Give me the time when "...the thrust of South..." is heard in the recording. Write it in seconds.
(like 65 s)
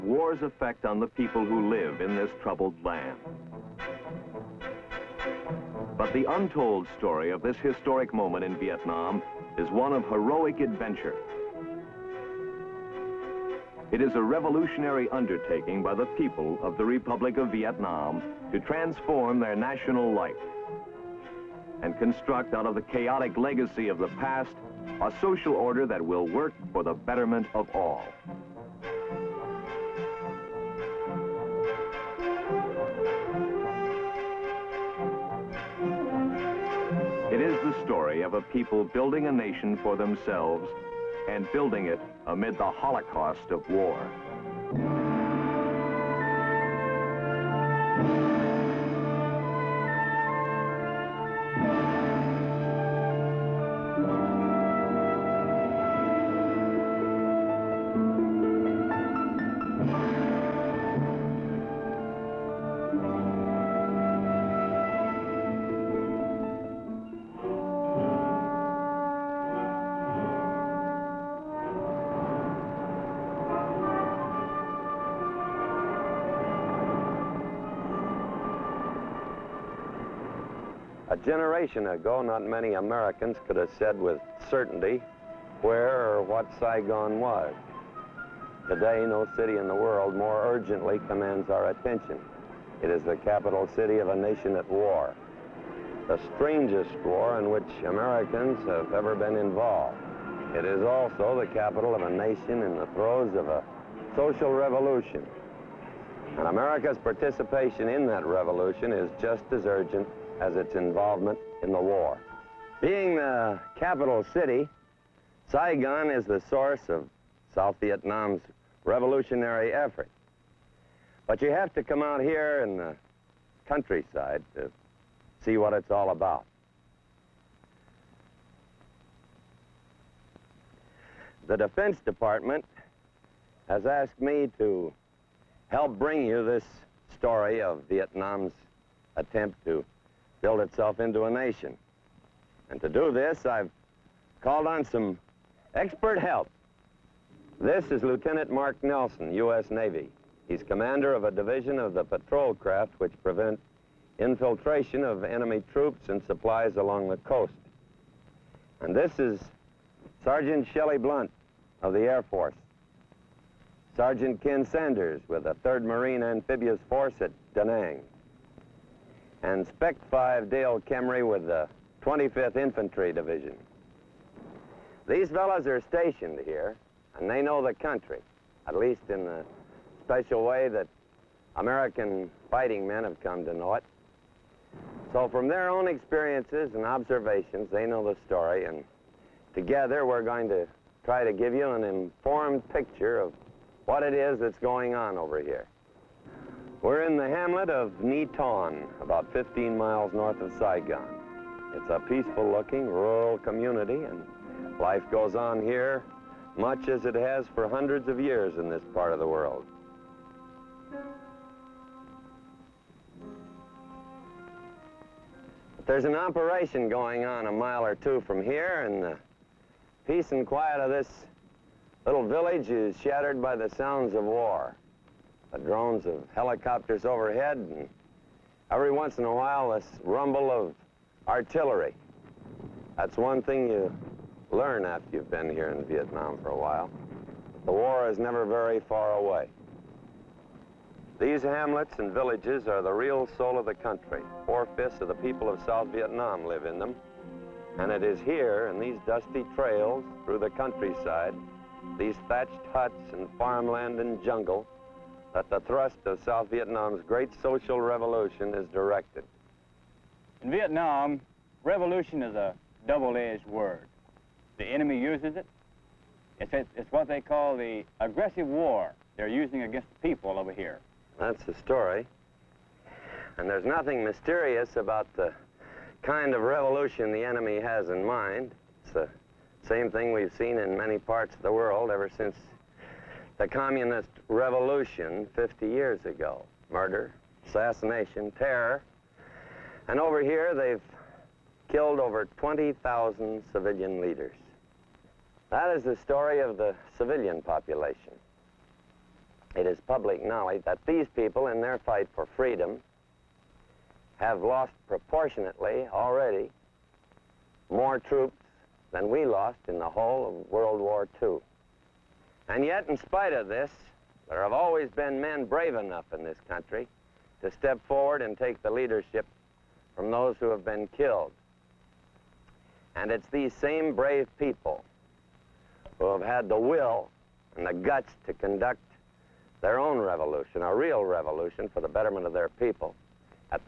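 255 s.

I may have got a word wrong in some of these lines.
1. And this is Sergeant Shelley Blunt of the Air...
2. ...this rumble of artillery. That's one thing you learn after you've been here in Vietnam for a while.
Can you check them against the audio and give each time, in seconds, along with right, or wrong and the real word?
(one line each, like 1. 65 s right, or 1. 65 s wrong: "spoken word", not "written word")
1. 158 s right
2. 229 s right.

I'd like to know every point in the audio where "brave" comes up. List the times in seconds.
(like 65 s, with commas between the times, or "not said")
315 s, 323 s.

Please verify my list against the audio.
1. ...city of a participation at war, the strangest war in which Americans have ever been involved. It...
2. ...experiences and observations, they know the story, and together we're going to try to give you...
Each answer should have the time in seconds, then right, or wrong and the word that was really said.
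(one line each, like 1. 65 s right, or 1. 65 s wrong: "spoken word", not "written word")
1. 93 s wrong: "nation", not "participation"
2. 185 s right.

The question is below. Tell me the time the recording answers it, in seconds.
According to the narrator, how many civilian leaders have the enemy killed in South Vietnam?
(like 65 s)
291 s.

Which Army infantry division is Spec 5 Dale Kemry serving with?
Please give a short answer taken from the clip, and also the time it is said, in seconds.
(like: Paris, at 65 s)
25th Infantry Division, at 172 s.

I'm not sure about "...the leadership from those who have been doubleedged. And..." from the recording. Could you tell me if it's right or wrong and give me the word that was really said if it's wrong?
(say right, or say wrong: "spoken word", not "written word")
wrong: "killed", not "doubleedged".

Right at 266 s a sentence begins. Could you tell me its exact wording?
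It's, it's what they call the aggressive war they're using against the people over here.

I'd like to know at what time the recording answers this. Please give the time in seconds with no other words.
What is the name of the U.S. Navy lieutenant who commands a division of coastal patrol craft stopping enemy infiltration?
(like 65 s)
148 s.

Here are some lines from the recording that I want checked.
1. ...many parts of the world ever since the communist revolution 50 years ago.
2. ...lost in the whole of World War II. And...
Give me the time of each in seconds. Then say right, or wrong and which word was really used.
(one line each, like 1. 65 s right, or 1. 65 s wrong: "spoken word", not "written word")
1. 280 s right
2. 309 s right.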